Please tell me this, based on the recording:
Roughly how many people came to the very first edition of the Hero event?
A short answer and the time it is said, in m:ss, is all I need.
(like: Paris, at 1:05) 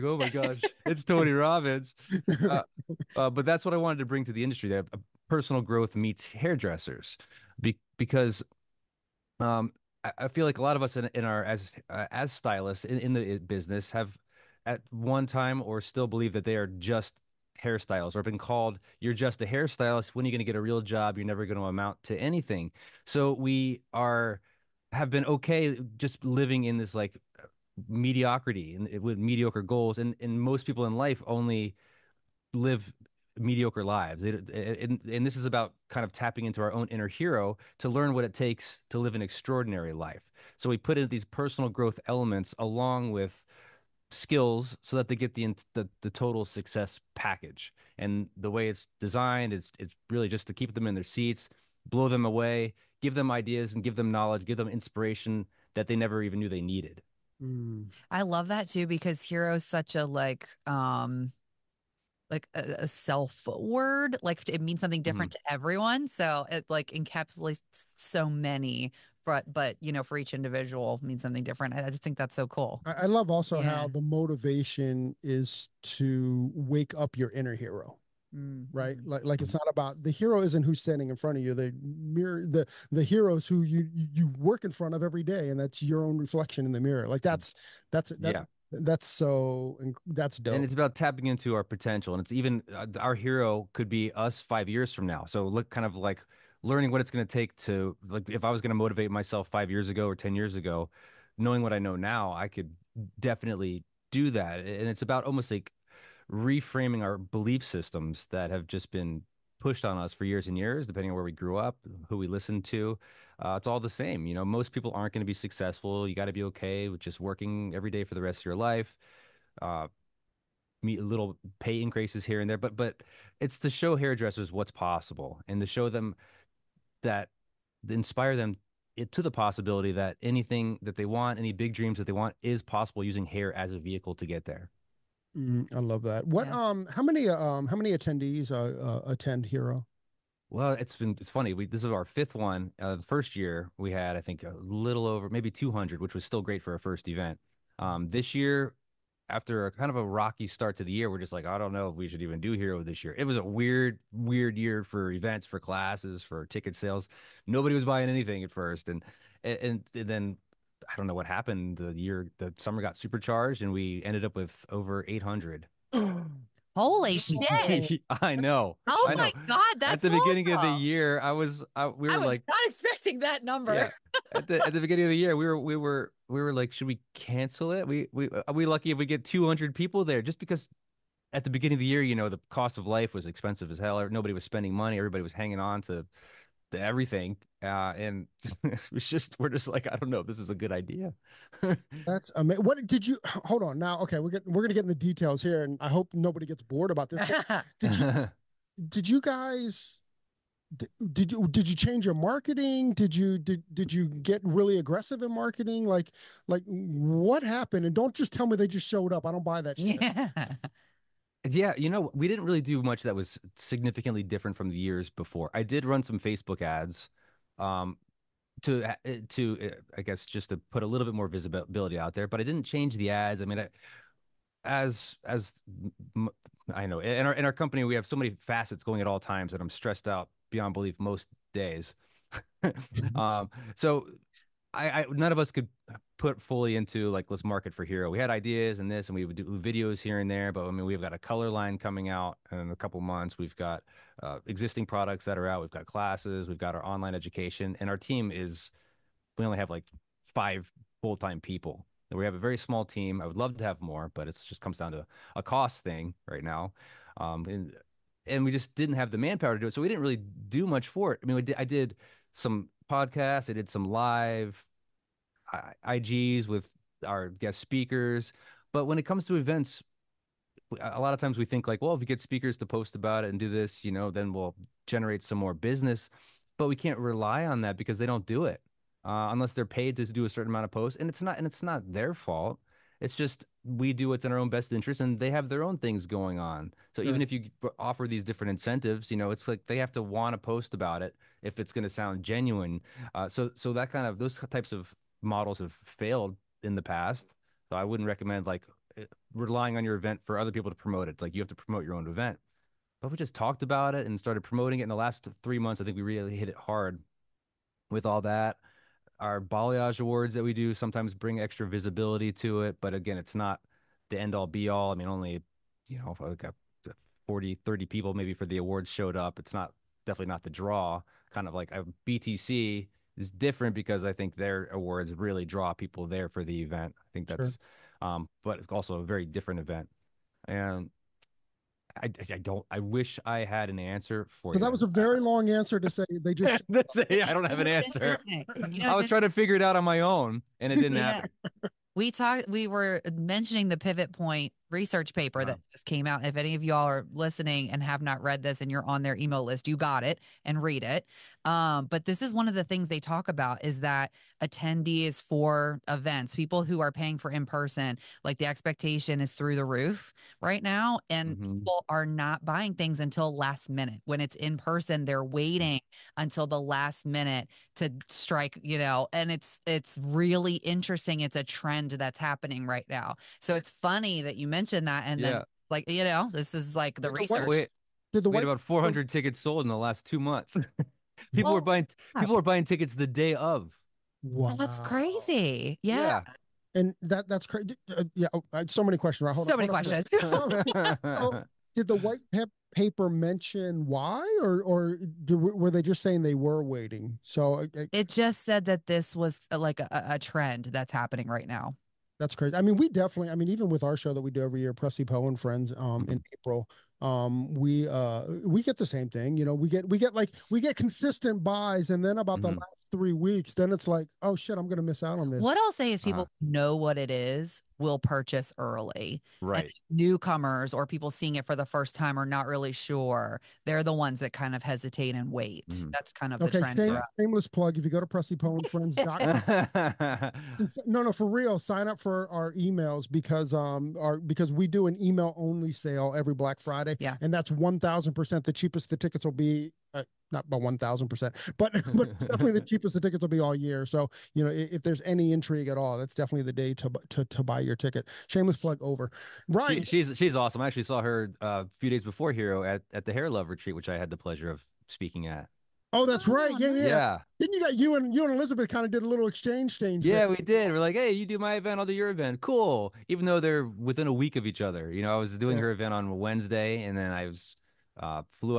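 200, at 2:24.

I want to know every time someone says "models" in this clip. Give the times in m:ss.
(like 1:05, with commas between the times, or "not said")
4:55.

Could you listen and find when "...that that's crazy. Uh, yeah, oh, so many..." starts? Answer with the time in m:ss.
6:27.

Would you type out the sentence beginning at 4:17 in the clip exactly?
Um, and and we just didn't have the manpower to do it.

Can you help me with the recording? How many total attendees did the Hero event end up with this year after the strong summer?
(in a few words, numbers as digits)
over 800.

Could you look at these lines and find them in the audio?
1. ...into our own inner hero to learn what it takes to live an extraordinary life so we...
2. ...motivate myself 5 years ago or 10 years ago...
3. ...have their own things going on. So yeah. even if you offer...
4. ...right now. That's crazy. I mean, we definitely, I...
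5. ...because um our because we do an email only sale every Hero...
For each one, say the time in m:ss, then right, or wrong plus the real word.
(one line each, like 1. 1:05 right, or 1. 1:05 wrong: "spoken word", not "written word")
1. 0:36 right
2. 1:38 right
3. 4:45 right
4. 6:41 right
5. 7:13 wrong: "Black", not "Hero".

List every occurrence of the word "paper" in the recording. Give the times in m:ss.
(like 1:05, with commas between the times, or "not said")
5:45, 6:32.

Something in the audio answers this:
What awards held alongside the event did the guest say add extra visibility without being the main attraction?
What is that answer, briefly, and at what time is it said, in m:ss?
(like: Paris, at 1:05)
balayage awards, at 5:09.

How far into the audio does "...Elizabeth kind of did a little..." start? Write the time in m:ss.
7:38.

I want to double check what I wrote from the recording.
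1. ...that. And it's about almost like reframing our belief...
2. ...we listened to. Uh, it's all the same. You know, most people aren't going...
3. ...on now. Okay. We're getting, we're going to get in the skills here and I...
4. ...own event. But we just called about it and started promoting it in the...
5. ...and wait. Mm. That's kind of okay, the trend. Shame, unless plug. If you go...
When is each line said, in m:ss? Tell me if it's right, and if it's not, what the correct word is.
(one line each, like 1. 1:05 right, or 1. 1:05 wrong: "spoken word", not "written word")
1. 1:44 right
2. 1:52 right
3. 3:13 wrong: "details", not "skills"
4. 5:01 wrong: "talked", not "called"
5. 7:05 wrong: "shameless", not "unless".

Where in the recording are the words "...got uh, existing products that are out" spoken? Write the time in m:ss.
4:03.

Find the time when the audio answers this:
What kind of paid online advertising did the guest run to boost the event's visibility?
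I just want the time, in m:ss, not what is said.
3:36.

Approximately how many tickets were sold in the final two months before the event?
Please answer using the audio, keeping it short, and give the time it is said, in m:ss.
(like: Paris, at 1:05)
400, at 6:18.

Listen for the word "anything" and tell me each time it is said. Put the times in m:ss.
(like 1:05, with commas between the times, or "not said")
0:22, 2:10, 2:38.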